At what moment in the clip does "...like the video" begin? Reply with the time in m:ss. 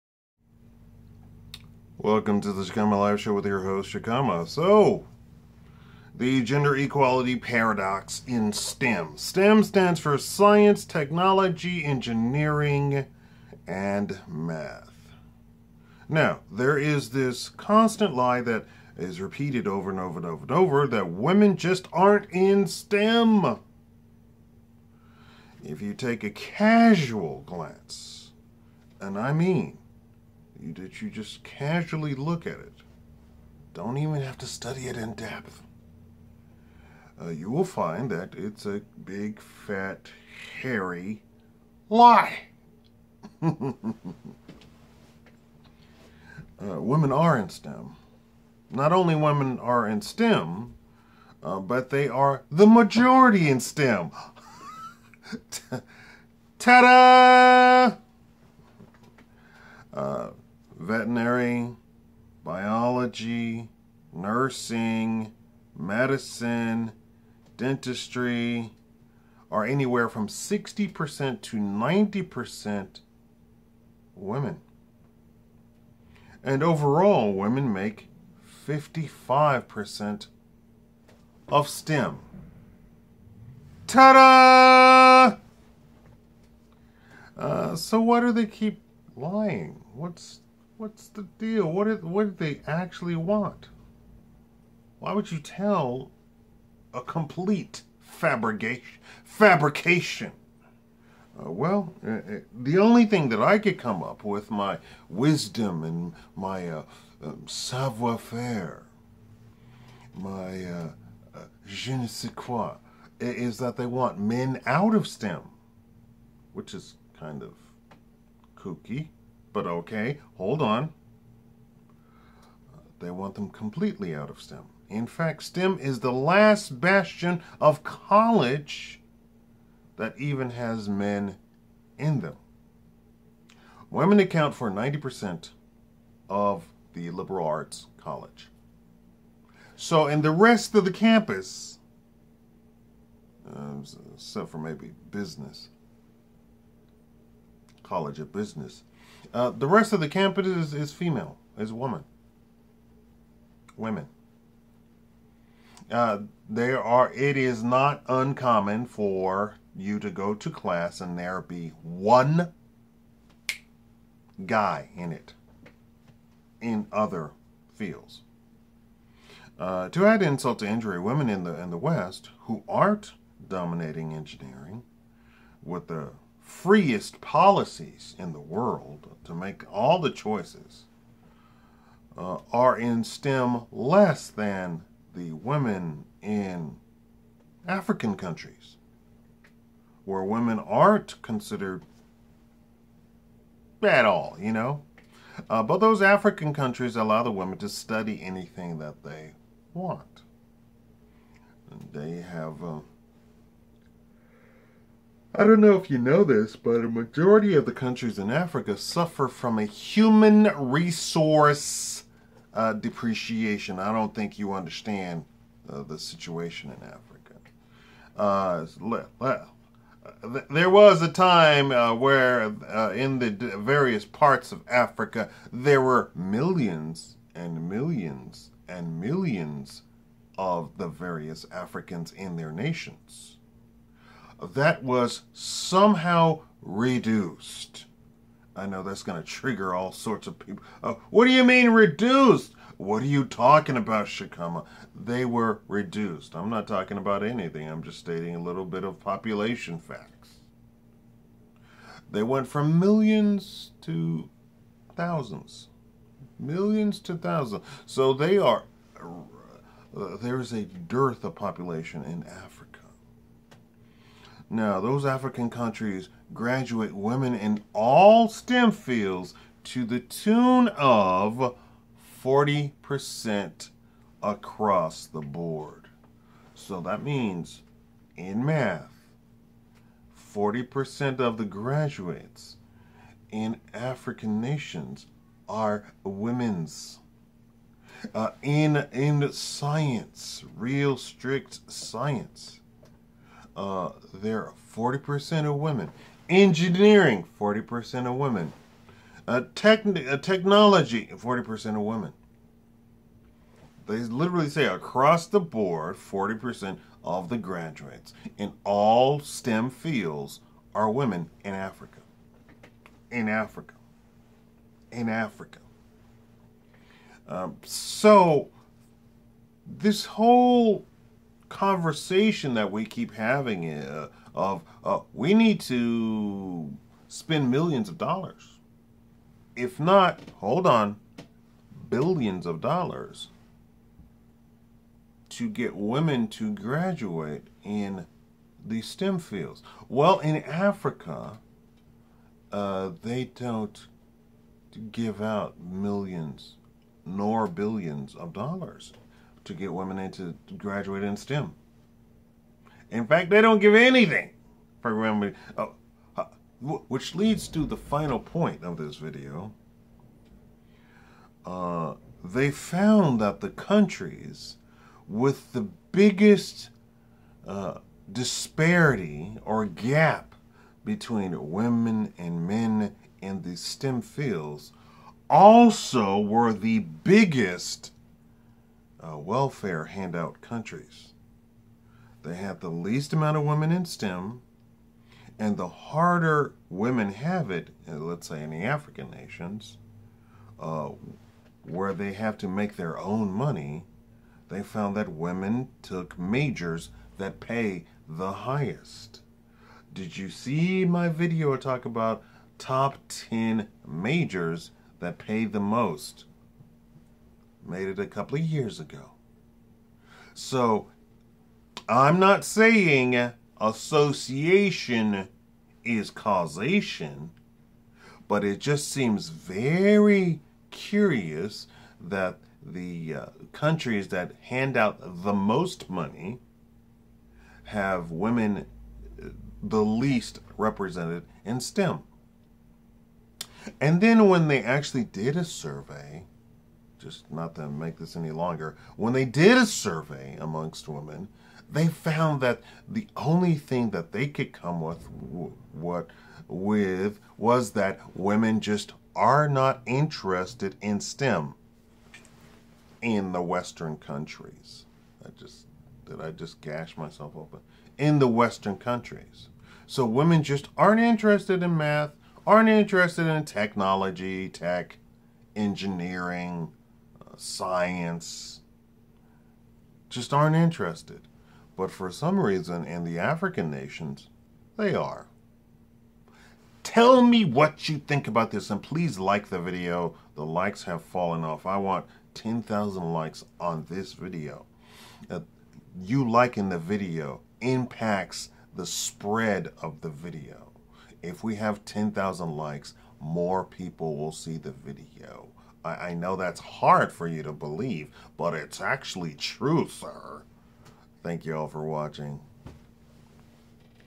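7:59.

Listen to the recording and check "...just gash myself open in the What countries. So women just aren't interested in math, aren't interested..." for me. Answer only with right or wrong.
wrong.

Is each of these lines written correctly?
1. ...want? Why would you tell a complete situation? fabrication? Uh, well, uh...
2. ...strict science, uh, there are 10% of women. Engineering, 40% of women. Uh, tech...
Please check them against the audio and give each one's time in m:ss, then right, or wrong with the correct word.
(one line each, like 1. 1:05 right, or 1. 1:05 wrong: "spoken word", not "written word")
1. 1:33 wrong: "fabrication", not "situation"
2. 4:50 wrong: "40", not "10".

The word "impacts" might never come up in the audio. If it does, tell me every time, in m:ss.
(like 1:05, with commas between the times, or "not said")
8:07.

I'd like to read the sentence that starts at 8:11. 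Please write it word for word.
If we have 10,000 likes, more people will see the video.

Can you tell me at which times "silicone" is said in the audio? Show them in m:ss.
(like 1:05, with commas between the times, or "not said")
not said.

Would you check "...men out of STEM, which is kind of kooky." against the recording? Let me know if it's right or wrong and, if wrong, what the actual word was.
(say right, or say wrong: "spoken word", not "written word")
right.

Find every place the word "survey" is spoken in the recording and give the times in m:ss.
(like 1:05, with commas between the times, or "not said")
7:15, 7:19.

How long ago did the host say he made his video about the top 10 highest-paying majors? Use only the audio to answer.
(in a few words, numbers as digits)
A couple of years ago.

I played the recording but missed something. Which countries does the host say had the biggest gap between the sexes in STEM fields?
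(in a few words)
Welfare handout countries.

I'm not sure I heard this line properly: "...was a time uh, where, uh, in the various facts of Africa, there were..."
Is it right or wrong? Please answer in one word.
wrong.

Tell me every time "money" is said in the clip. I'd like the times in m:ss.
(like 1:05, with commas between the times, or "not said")
6:33, 7:05.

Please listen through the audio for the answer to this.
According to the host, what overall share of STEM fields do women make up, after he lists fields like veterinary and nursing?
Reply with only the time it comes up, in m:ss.
1:18.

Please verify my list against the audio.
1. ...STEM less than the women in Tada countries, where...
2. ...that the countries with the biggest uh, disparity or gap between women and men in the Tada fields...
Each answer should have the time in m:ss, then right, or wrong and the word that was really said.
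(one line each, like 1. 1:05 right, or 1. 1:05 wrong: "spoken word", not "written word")
1. 3:03 wrong: "African", not "Tada"
2. 6:03 wrong: "STEM", not "Tada".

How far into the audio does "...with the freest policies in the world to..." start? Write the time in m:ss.
2:55.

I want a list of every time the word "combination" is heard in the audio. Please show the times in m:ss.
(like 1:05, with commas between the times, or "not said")
not said.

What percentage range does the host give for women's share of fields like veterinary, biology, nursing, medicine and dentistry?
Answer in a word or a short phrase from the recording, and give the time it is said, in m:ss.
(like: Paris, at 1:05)
60% to 90%, at 1:10.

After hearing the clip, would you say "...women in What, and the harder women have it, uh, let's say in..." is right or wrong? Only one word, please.
wrong.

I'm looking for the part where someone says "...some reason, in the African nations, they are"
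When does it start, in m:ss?
7:52.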